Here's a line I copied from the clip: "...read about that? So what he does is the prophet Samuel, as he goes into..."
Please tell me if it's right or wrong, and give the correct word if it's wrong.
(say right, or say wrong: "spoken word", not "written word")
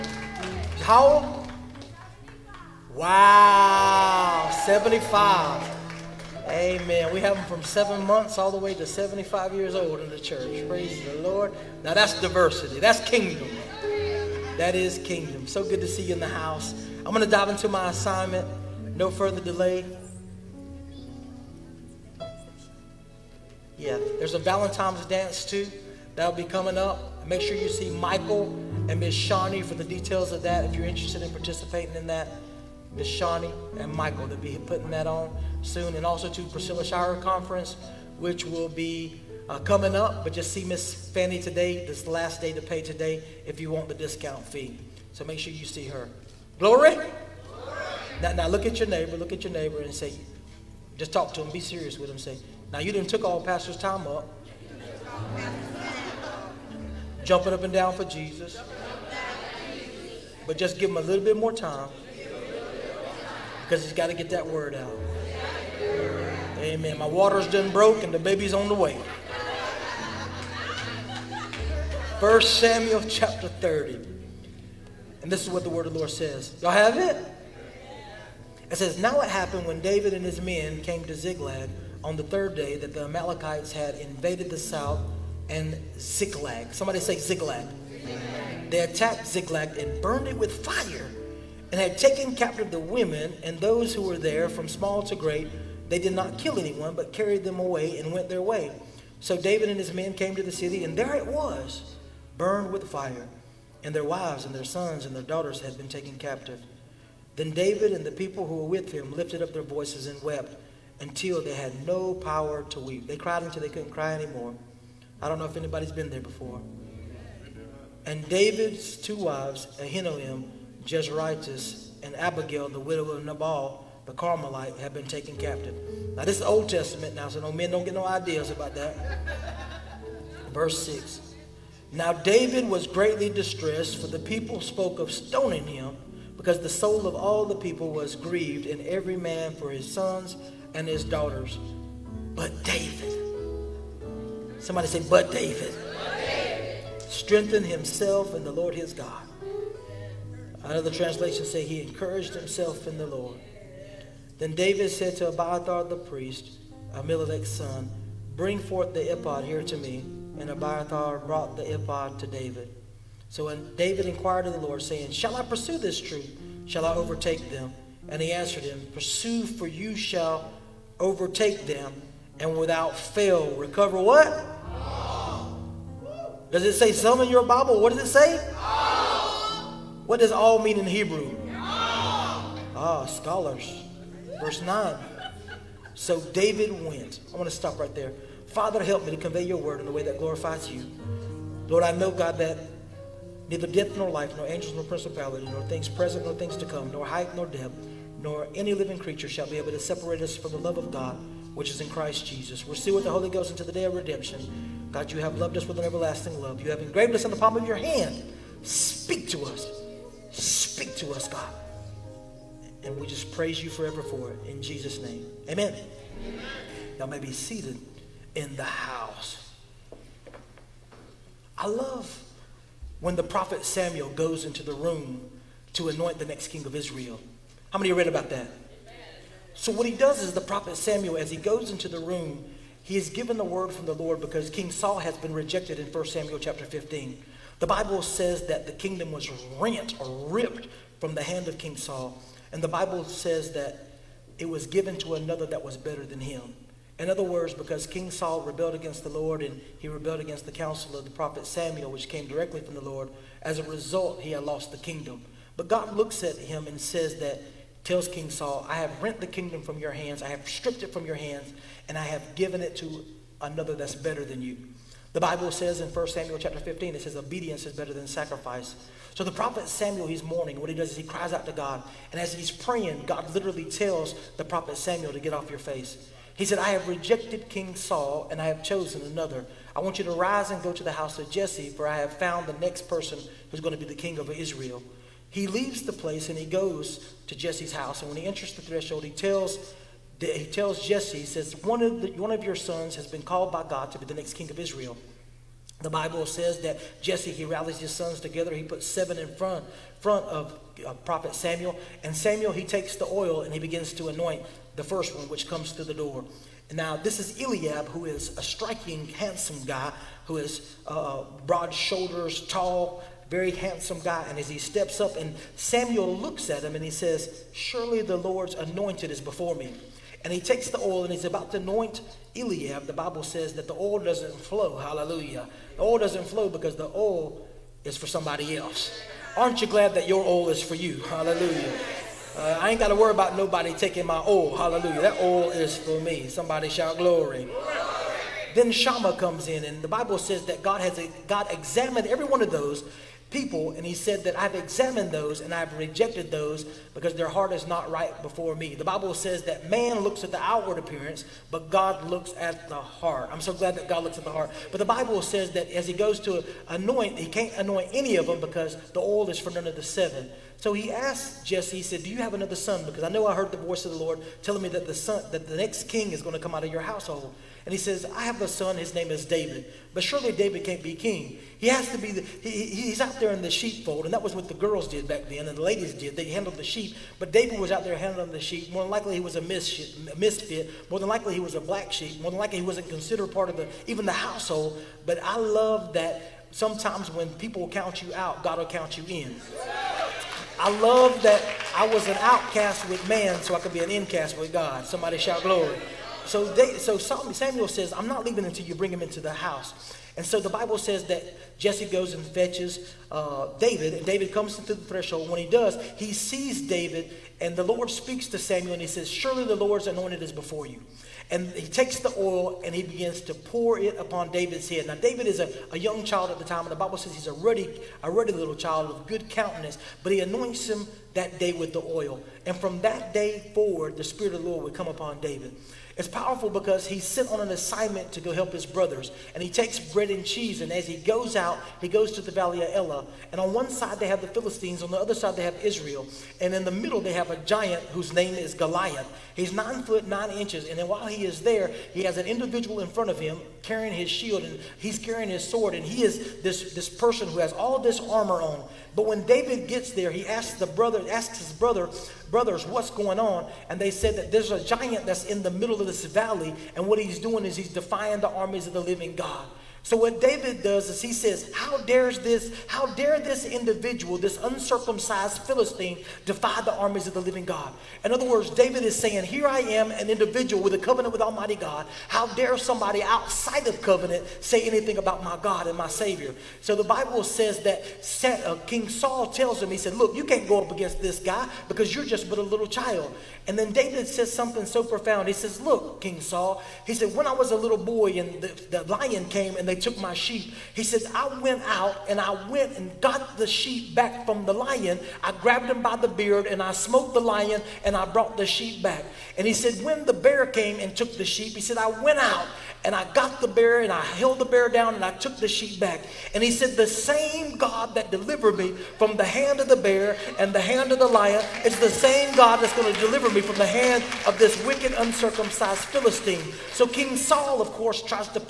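right.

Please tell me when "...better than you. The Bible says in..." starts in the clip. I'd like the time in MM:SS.
04:23.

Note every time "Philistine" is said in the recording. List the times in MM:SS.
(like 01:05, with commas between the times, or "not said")
07:14, 07:45, 08:35.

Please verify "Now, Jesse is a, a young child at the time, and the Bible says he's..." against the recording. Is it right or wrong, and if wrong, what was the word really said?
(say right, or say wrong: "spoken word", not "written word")
wrong: "David", not "Jesse".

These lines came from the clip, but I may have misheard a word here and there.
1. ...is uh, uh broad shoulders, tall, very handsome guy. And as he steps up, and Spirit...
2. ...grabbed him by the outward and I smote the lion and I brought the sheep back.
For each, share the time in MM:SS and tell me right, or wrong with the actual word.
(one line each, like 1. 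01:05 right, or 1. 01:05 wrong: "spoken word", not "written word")
1. 05:10 wrong: "Samuel", not "Spirit"
2. 08:15 wrong: "beard", not "outward".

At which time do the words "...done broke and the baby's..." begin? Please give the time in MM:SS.
01:07.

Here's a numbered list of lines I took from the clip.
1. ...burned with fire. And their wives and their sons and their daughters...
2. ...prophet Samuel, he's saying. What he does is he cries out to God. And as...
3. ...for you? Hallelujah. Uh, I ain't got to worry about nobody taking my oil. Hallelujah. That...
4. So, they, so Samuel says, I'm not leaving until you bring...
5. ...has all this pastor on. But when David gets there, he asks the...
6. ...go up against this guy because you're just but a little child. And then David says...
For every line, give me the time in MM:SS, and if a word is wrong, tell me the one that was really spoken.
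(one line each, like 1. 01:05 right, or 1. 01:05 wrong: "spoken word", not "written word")
1. 01:42 right
2. 04:29 wrong: "mourning", not "saying"
3. 05:30 right
4. 06:36 right
5. 07:27 wrong: "armor", not "pastor"
6. 08:00 right.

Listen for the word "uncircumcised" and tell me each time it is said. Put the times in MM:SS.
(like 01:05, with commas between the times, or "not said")
07:44, 08:34.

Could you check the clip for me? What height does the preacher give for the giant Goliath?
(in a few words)
9 feet 9 inches.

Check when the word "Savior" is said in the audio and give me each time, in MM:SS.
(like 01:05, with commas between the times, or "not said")
07:55.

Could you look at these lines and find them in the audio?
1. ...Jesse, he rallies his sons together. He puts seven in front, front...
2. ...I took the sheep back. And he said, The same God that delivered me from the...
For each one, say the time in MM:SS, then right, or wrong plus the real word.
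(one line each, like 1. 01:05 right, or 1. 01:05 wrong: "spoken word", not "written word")
1. 04:57 right
2. 08:25 right.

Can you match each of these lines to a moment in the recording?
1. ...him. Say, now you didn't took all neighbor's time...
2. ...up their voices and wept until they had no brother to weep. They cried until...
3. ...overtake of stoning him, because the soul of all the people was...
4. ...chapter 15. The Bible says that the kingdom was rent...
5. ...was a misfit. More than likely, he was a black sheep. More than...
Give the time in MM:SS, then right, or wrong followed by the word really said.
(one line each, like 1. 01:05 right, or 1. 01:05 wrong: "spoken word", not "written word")
1. 00:52 wrong: "pastor", not "neighbor"
2. 01:49 wrong: "power", not "brother"
3. 02:14 wrong: "spoke", not "overtake"
4. 03:56 right
5. 06:19 right.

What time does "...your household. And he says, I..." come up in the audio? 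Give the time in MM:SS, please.
06:06.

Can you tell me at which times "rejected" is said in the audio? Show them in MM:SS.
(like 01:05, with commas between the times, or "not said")
03:55, 04:36, 05:45.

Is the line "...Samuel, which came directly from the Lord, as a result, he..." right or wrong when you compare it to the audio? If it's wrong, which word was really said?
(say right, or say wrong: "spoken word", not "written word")
right.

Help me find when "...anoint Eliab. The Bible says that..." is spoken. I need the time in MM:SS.
05:21.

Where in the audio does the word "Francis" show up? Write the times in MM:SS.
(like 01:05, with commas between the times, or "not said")
not said.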